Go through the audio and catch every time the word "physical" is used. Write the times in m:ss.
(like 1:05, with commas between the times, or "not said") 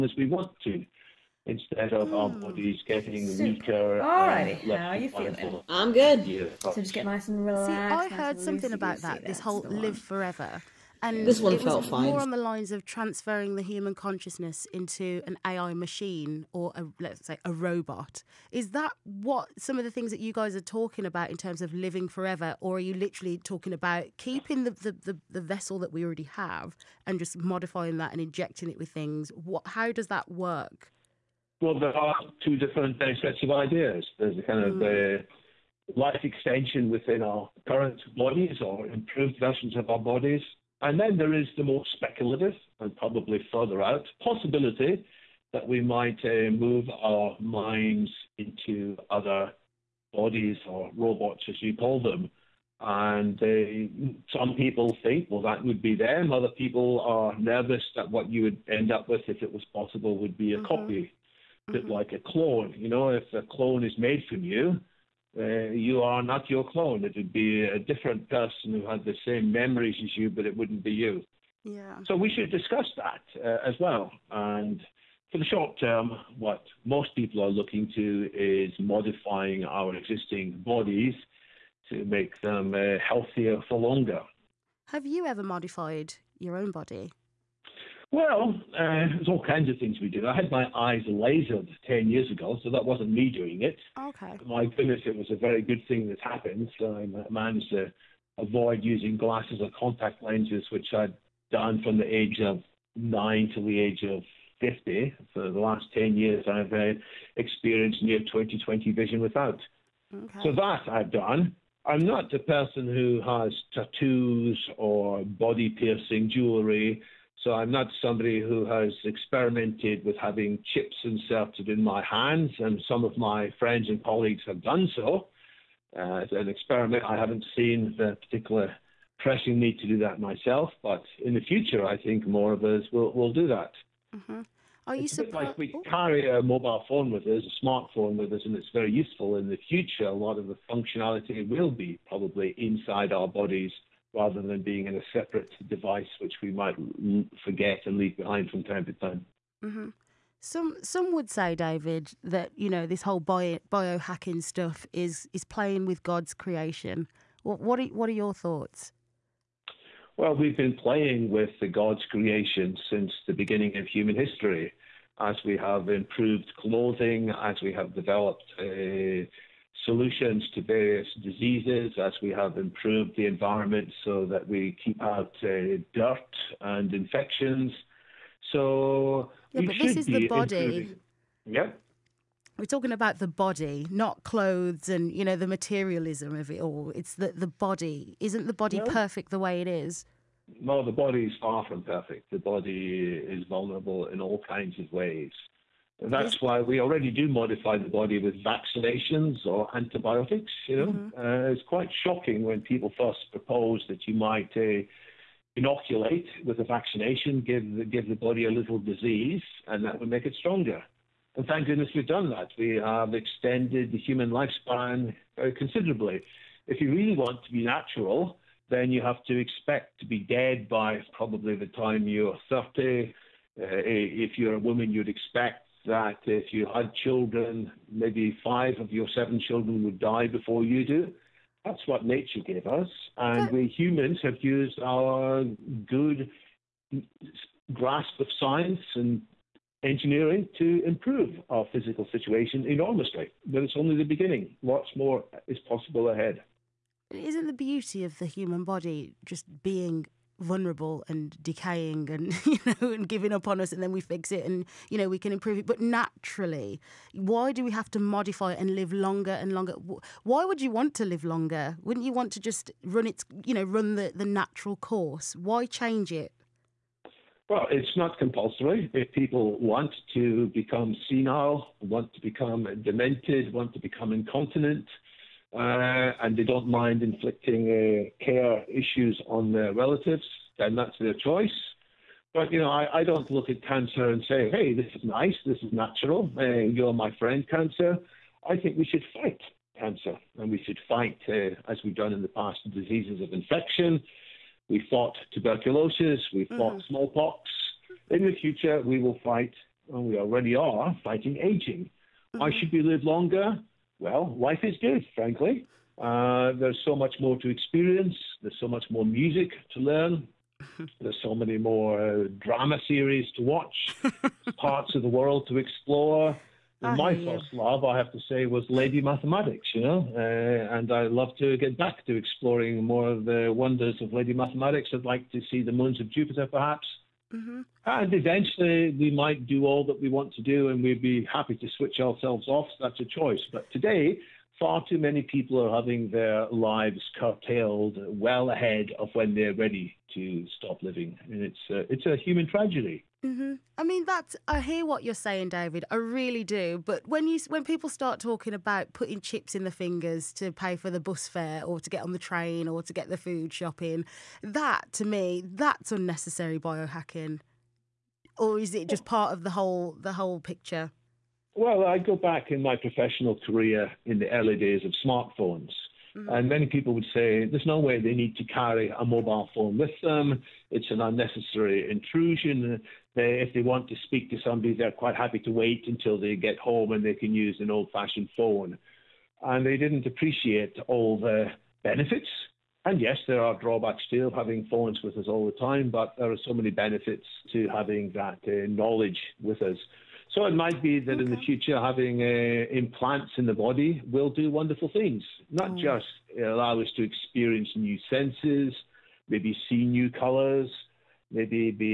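4:01.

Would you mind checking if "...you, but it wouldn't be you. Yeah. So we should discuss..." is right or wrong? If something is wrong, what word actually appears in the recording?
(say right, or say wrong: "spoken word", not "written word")
right.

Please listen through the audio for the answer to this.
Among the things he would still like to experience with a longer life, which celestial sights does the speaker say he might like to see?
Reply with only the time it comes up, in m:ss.
5:25.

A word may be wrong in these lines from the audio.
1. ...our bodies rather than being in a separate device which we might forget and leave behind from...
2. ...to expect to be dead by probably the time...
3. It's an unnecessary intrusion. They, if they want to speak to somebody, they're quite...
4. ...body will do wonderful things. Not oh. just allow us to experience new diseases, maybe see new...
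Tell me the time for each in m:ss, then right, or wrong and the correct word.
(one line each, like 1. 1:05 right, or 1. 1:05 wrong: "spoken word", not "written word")
1. 2:23 right
2. 3:39 right
3. 6:10 right
4. 6:33 wrong: "senses", not "diseases".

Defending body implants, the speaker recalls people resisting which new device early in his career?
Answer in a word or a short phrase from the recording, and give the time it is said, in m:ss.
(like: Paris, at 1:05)
Smartphones, at 6:05.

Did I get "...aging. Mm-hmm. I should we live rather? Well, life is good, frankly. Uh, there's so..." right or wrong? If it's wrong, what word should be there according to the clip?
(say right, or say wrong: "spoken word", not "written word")
wrong: "longer", not "rather".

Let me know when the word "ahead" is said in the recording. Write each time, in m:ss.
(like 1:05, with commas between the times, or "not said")
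4:06, 5:38.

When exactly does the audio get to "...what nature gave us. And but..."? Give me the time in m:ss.
3:51.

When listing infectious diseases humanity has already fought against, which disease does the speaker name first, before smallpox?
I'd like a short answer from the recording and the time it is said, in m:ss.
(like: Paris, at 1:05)
Tuberculosis, at 4:55.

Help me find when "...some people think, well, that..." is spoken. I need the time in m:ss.
0:54.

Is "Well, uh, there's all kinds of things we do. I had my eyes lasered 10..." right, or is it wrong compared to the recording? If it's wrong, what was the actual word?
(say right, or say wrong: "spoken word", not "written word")
right.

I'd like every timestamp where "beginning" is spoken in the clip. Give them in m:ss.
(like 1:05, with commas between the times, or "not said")
2:43, 4:04.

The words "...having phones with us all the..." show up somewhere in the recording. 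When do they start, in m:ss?
6:24.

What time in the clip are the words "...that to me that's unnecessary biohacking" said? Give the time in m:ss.
5:54.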